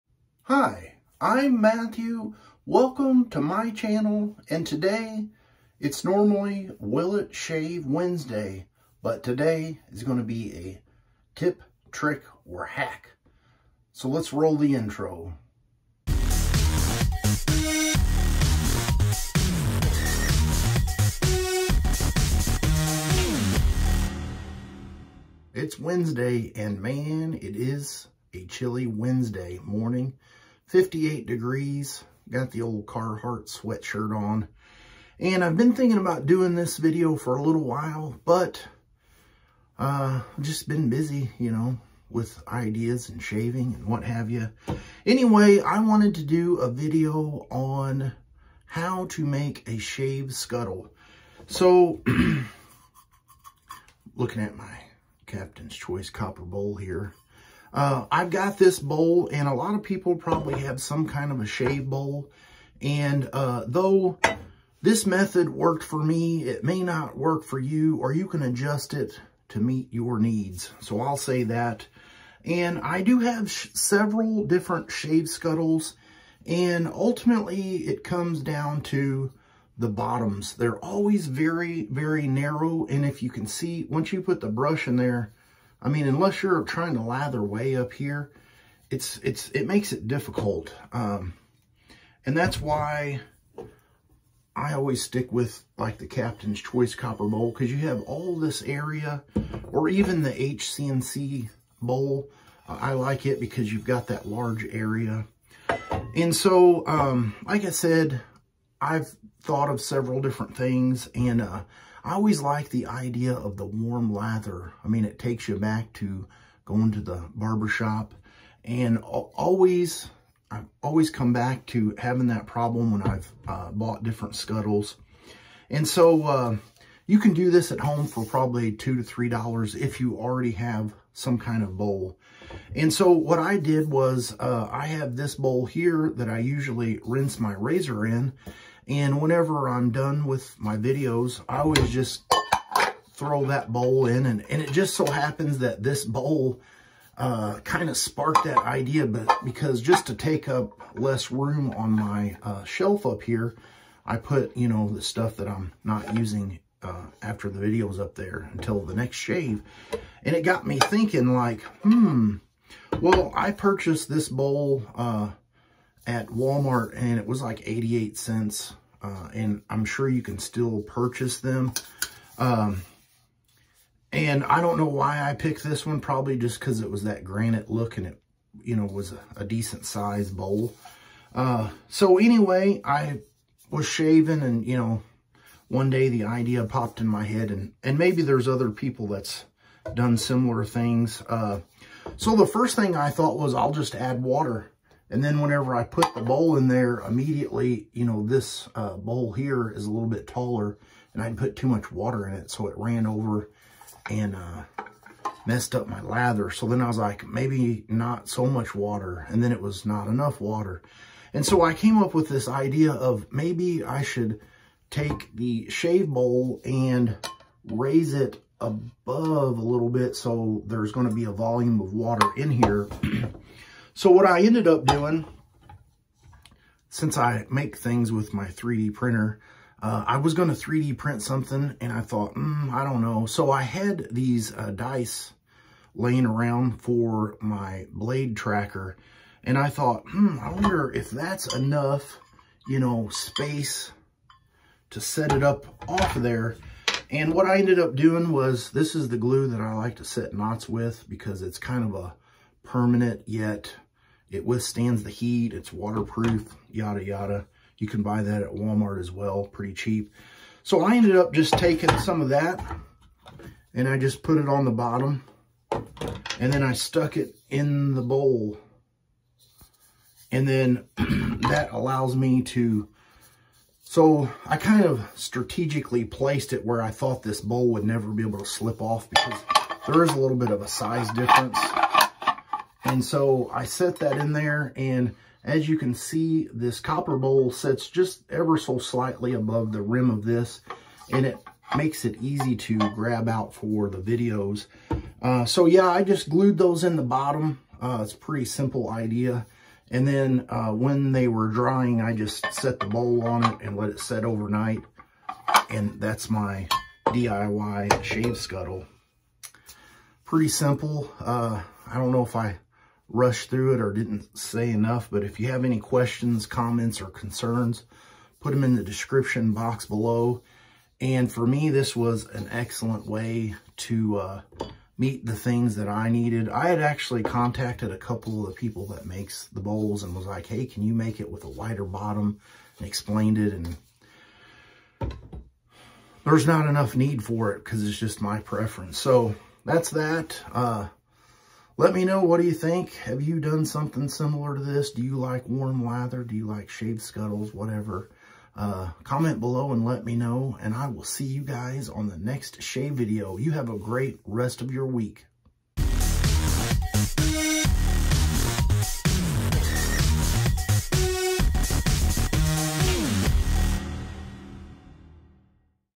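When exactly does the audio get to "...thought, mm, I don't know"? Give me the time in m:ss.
3:52.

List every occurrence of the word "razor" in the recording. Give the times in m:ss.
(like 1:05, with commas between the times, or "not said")
2:17.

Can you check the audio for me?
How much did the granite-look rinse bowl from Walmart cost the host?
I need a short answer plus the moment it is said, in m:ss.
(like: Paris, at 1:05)
88 cents, at 2:47.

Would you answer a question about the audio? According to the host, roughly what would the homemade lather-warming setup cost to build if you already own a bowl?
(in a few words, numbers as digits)
2 to 3 dollars.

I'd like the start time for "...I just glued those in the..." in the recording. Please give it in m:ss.
4:55.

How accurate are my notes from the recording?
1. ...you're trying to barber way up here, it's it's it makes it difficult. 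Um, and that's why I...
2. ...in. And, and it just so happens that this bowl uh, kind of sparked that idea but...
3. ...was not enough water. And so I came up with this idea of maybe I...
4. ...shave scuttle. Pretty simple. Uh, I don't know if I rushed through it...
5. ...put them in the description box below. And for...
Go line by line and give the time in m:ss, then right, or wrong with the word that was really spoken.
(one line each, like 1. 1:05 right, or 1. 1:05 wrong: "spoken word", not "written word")
1. 1:26 wrong: "lather", not "barber"
2. 2:24 right
3. 3:29 right
4. 5:08 right
5. 5:18 right.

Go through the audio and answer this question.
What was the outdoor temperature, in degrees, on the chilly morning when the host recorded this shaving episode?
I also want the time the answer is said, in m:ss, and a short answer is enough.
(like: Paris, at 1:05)
58, at 0:30.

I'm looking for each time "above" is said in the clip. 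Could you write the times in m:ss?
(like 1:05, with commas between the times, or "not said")
3:38, 4:49.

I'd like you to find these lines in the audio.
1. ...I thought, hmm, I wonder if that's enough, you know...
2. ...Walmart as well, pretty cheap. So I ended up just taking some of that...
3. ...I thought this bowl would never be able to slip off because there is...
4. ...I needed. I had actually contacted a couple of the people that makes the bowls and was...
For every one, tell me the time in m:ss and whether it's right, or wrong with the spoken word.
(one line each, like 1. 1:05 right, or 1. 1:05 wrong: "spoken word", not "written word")
1. 3:59 right
2. 4:18 right
3. 4:36 right
4. 5:25 right.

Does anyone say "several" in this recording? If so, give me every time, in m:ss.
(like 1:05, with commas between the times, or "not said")
1:13, 1:49.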